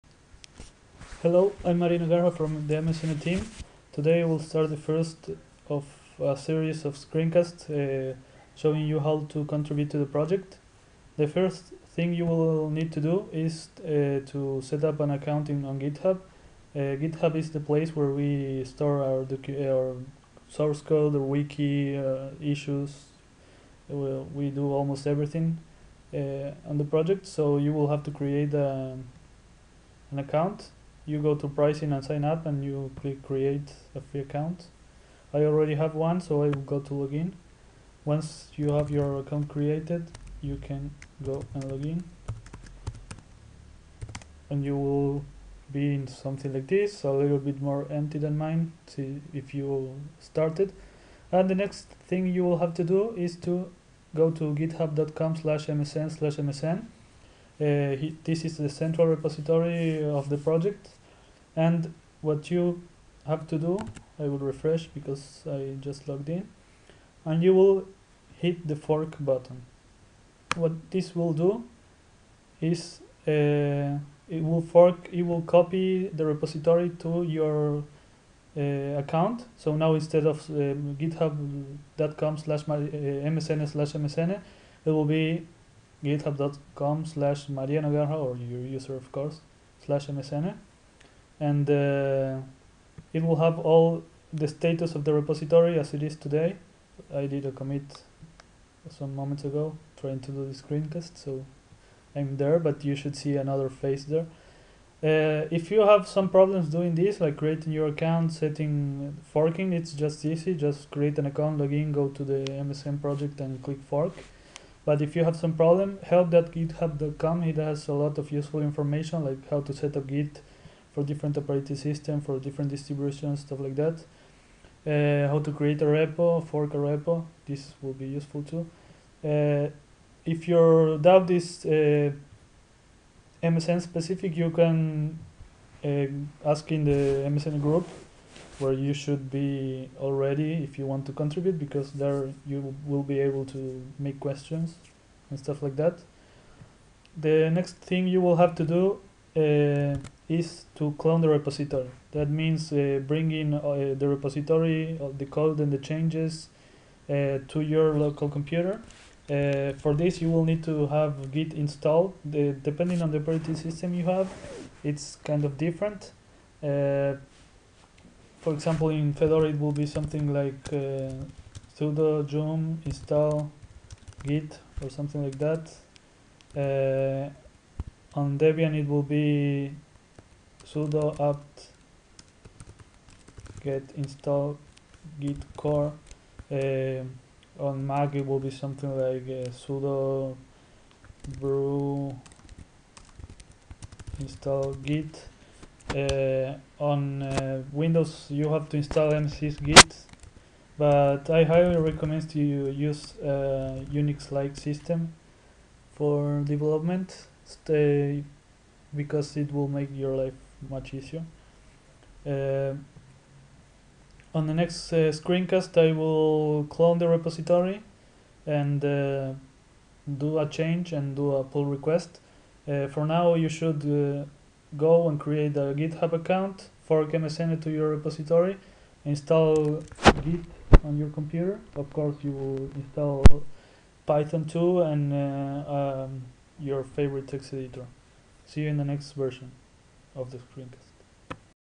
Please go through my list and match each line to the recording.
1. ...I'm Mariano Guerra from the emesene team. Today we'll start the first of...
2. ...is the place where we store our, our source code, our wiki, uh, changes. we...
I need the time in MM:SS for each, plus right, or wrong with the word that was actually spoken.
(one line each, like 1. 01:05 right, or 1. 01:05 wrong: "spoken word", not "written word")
1. 00:01 right
2. 00:17 wrong: "issues", not "changes".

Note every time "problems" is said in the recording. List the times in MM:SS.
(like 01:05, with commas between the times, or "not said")
01:46, 01:55.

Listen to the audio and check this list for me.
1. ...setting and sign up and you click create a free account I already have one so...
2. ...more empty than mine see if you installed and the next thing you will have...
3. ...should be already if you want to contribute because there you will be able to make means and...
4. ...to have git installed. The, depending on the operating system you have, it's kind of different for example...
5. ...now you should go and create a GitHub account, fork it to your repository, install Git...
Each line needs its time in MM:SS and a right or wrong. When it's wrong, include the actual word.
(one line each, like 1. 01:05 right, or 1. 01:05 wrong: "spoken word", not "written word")
1. 00:31 wrong: "pricing", not "setting"
2. 00:47 wrong: "started", not "installed"
3. 02:18 wrong: "questions", not "means"
4. 02:40 right
5. 03:43 right.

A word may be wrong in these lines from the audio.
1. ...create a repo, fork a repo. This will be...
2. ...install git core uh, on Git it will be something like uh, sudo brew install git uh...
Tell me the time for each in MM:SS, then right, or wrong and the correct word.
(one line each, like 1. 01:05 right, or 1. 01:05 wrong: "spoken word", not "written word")
1. 02:05 right
2. 03:03 wrong: "Mac", not "Git".